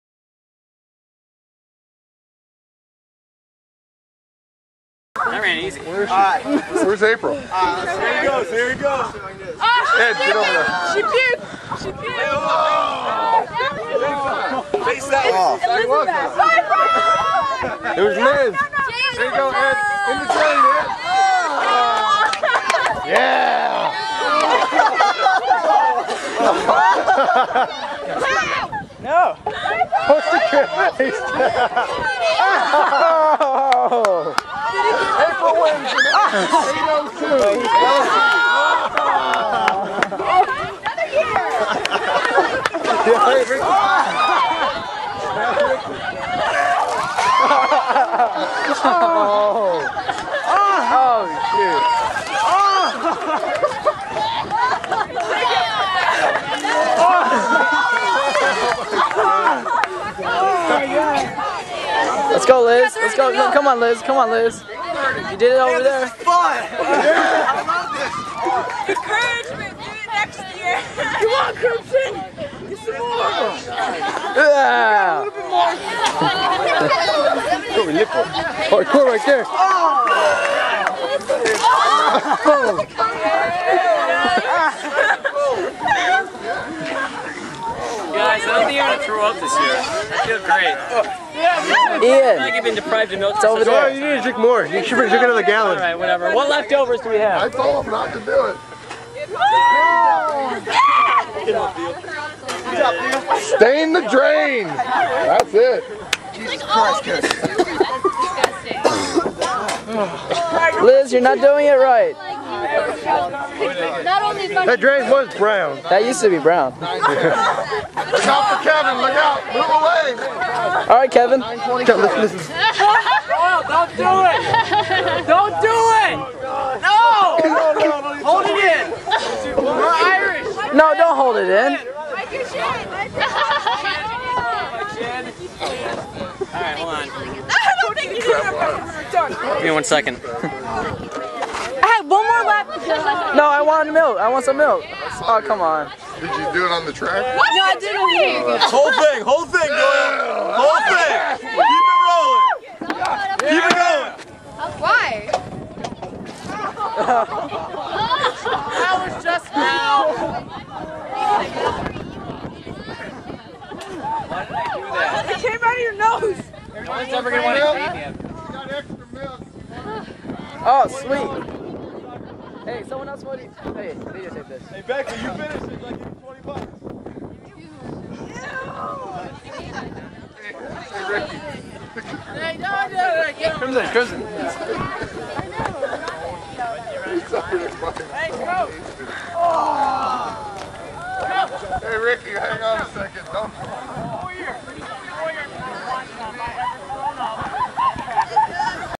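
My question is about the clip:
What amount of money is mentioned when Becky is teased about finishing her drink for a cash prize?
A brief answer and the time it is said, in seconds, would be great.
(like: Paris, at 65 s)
20 bucks, at 176 s.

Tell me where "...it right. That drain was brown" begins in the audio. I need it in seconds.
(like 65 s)
111 s.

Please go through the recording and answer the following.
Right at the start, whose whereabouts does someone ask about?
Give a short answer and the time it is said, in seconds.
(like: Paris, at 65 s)
April, at 7 s.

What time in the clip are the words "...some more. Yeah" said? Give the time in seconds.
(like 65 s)
72 s.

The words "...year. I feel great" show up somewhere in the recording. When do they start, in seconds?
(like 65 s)
89 s.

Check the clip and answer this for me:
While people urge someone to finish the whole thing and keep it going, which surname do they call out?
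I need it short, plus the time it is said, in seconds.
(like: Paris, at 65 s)
Doyle, at 149 s.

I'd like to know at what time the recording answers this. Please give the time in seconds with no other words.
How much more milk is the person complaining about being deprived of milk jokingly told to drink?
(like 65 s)
95 s.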